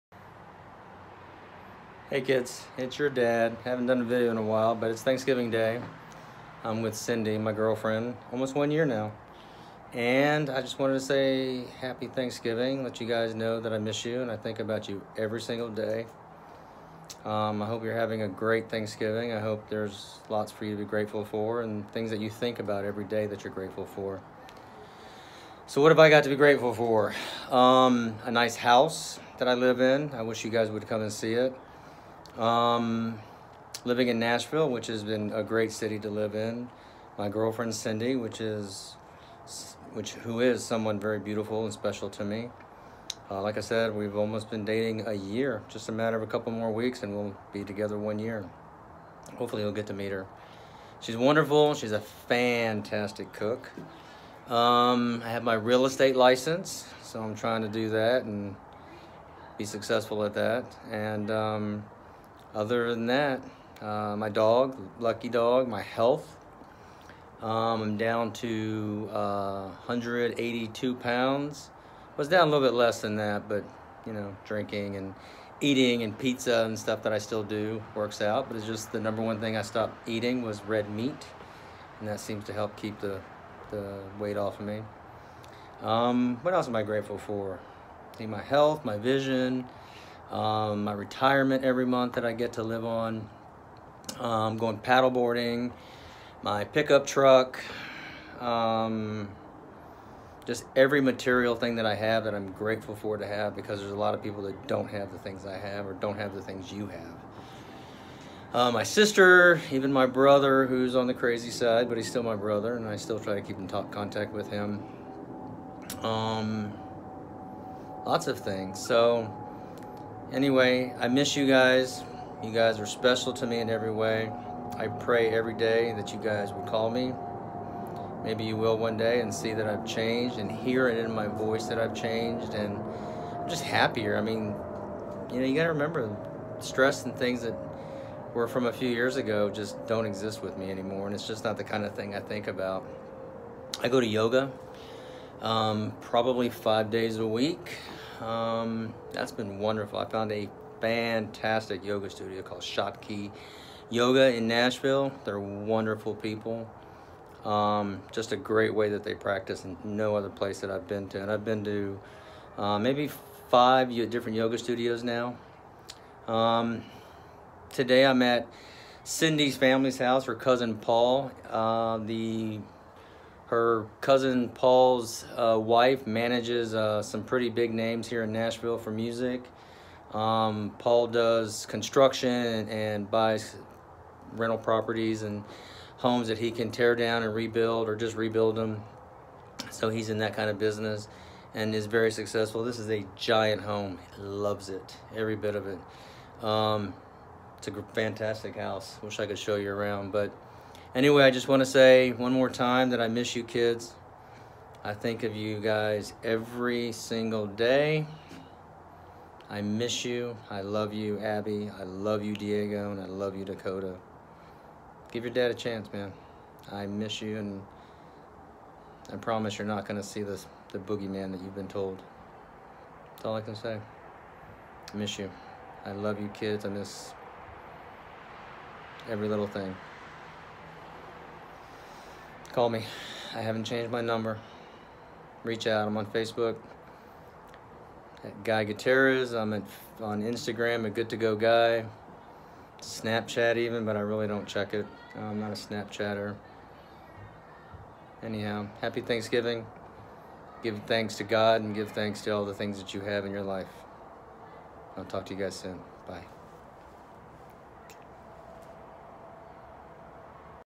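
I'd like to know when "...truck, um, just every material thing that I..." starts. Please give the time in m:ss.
1:37.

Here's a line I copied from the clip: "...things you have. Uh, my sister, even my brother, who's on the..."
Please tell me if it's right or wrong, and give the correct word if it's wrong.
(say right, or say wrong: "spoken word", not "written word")
right.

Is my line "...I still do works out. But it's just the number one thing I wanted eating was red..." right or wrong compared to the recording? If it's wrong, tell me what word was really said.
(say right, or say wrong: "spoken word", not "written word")
wrong: "stopped", not "wanted".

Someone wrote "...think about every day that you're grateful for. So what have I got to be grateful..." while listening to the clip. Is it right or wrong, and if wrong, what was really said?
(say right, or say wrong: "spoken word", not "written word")
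right.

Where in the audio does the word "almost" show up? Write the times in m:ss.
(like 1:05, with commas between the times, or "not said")
0:08, 0:44.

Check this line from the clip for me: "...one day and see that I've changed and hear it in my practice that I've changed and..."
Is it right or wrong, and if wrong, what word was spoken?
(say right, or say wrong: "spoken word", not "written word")
wrong: "voice", not "practice".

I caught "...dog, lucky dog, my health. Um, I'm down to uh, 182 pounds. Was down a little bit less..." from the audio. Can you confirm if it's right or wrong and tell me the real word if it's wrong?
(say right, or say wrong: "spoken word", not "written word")
right.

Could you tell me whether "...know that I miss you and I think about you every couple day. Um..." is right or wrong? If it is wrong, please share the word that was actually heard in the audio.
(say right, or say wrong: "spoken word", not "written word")
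wrong: "single", not "couple".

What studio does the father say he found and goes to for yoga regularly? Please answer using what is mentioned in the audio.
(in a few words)
Shopkey Yoga.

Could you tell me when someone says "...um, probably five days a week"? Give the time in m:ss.
2:25.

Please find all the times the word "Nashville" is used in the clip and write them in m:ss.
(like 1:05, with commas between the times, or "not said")
0:34, 2:34, 2:58.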